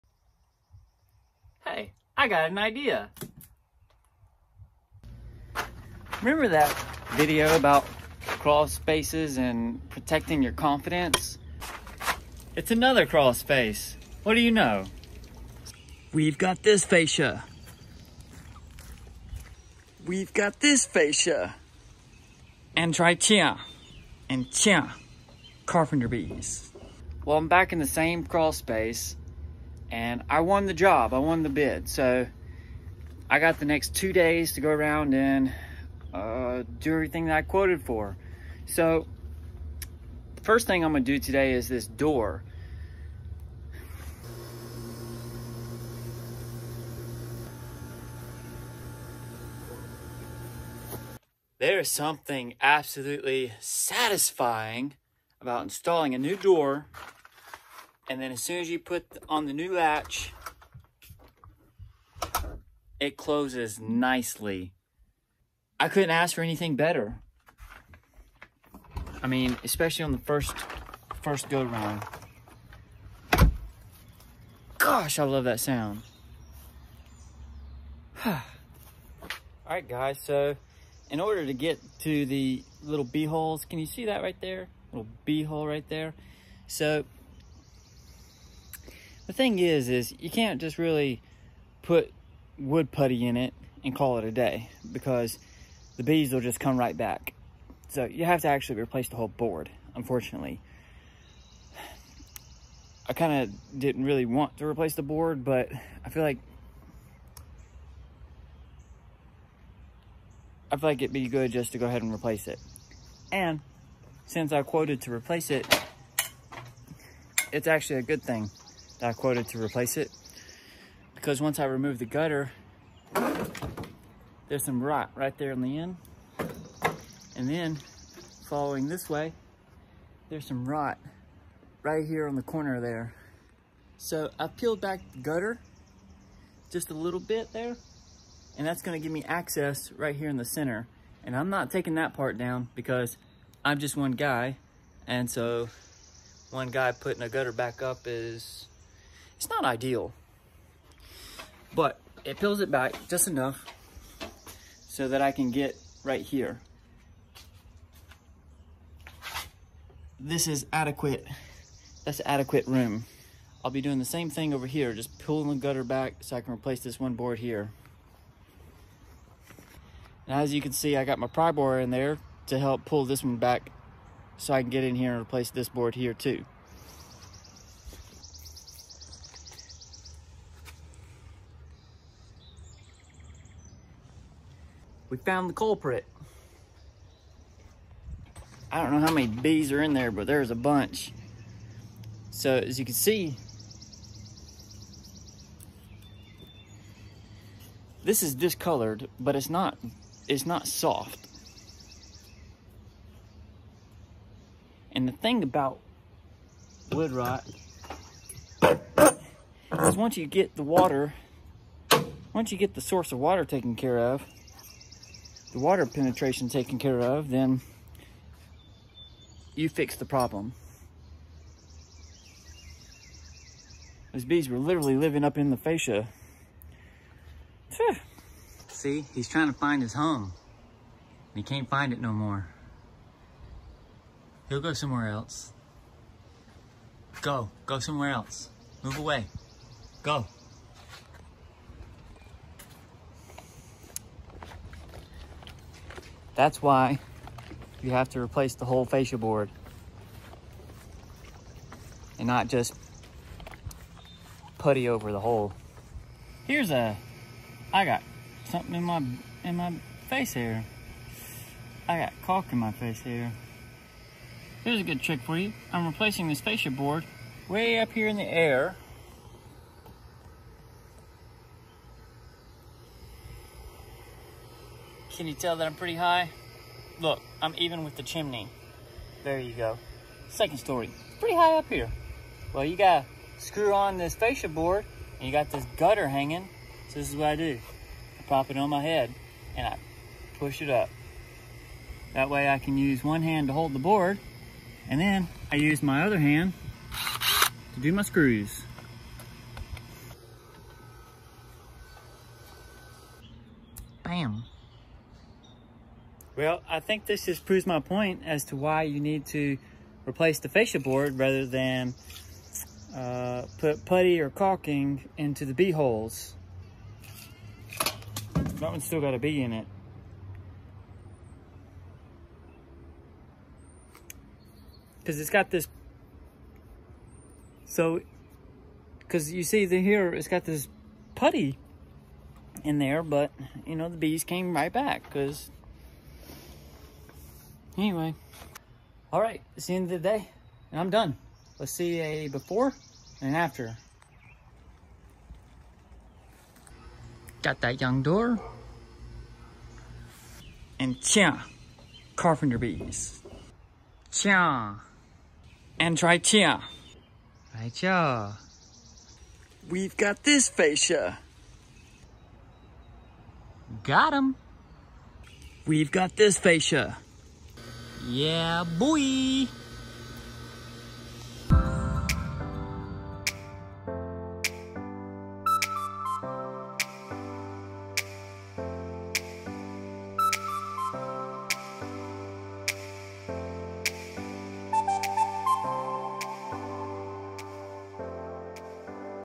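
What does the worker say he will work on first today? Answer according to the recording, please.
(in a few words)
this door.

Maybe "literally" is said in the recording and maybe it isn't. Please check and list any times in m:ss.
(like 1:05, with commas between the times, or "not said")
3:44.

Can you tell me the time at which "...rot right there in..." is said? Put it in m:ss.
2:04.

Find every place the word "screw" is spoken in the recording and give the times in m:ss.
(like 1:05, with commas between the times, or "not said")
4:43, 4:58.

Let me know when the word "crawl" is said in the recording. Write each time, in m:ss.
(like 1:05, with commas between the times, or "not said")
0:08, 0:13, 0:28.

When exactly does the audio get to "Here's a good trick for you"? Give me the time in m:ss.
4:24.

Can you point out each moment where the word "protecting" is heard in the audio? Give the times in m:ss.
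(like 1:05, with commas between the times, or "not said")
0:09.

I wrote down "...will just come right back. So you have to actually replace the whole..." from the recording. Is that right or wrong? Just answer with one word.
right.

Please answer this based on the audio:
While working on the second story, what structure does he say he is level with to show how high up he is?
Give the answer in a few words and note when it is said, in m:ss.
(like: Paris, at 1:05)
the chimney, at 4:37.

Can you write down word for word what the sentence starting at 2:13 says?
So I peeled back the gutter just a little bit there, and that's gonna give me access right here in the center.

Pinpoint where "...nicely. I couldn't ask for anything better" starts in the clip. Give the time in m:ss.
1:03.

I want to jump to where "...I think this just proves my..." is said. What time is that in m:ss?
5:06.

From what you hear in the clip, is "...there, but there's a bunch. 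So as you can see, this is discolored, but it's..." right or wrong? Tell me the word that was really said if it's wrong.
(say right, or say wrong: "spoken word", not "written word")
right.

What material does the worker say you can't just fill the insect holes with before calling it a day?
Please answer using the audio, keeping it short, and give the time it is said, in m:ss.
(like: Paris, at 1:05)
wood putty, at 1:32.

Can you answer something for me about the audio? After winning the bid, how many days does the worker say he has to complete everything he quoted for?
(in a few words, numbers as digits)
2.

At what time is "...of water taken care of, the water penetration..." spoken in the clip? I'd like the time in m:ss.
3:33.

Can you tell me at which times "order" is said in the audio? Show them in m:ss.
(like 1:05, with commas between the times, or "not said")
1:21.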